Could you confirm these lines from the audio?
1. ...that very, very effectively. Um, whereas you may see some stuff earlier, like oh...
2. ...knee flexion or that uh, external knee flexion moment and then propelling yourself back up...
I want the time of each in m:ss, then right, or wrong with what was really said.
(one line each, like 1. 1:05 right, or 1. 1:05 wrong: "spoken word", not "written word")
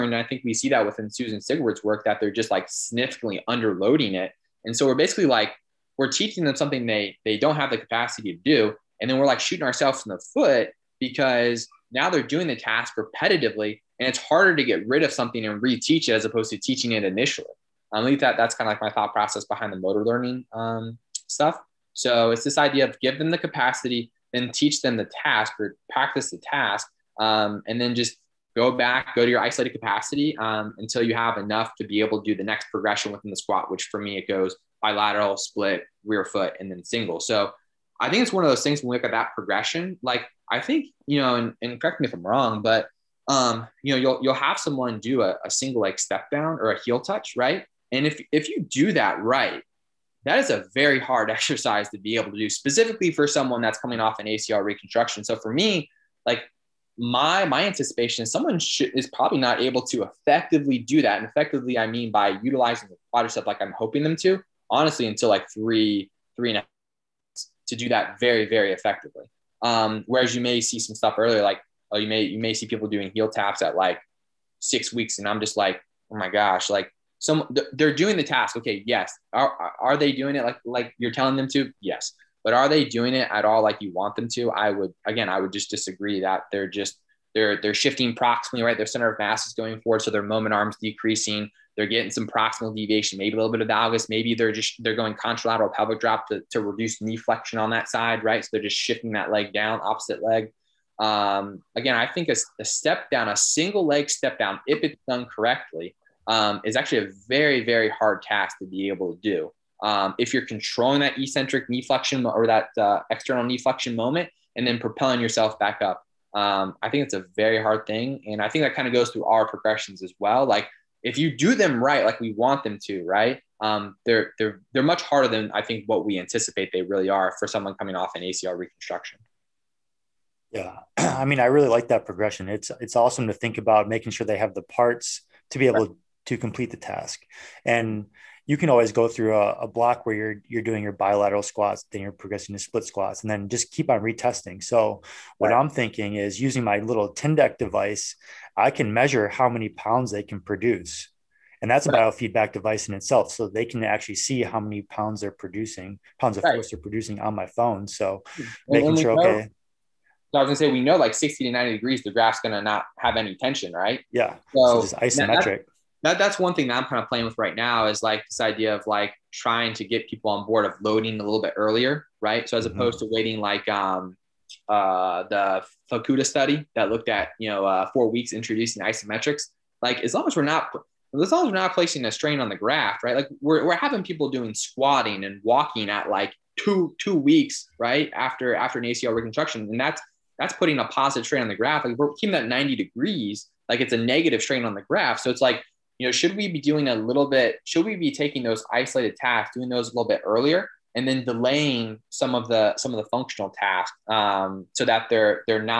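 1. 1:07 right
2. 1:51 right.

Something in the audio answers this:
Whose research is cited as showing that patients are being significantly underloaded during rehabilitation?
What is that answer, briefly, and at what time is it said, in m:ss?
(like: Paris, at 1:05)
Susan Sigward, at 0:01.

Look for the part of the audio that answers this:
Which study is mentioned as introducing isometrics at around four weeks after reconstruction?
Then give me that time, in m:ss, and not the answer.
2:55.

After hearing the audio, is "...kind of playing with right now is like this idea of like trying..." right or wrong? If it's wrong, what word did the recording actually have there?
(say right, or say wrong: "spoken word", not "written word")
right.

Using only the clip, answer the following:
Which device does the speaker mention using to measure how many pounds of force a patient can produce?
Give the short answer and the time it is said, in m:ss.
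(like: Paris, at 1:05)
Tindeq, at 2:27.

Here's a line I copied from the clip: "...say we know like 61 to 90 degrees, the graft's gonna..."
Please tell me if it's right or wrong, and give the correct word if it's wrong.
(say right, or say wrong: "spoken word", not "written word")
wrong: "60", not "61".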